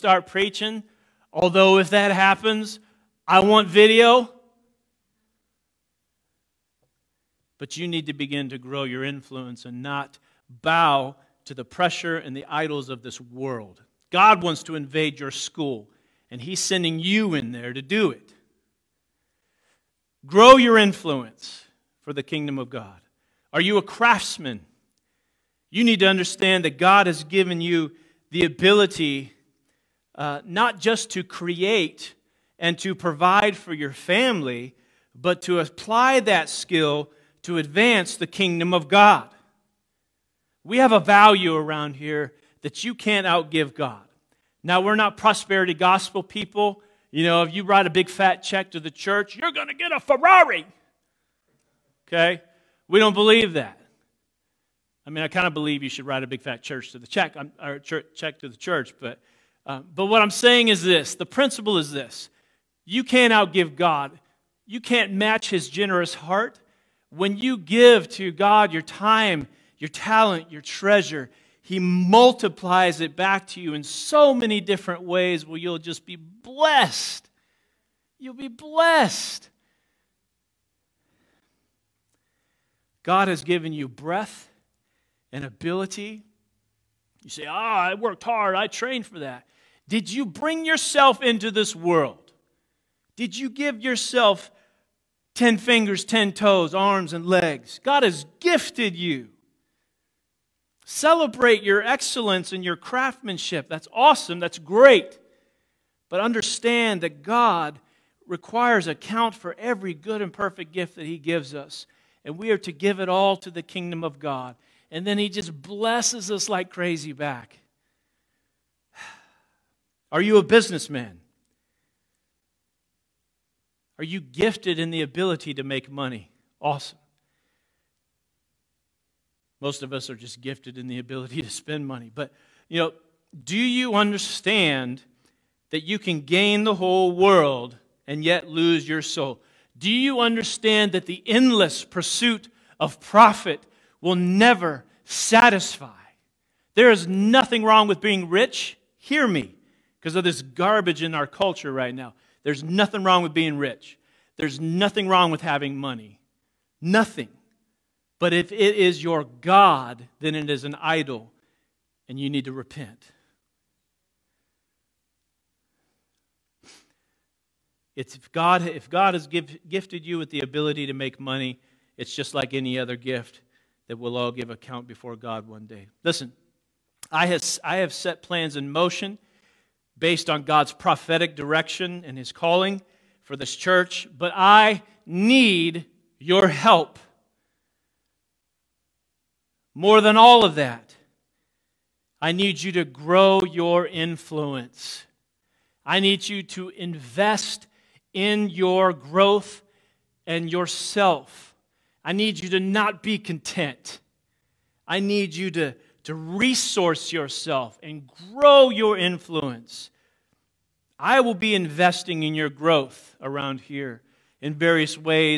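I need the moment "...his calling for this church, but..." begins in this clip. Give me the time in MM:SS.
03:02.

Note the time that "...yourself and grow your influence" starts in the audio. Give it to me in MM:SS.
03:27.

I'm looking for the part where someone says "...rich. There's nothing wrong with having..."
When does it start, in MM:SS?
02:33.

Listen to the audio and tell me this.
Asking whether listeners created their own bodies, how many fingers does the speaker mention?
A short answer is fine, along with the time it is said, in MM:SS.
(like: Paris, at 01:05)
10, at 01:35.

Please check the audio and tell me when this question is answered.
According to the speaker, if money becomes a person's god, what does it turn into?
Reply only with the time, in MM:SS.
02:40.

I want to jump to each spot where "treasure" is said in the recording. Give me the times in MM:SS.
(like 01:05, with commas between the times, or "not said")
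01:10.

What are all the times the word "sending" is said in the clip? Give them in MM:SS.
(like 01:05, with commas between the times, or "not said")
00:16.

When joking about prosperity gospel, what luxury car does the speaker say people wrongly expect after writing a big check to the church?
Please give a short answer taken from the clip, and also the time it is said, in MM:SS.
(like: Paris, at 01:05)
Ferrari, at 00:49.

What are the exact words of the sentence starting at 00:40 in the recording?
We have a value around here that you can't outgive God.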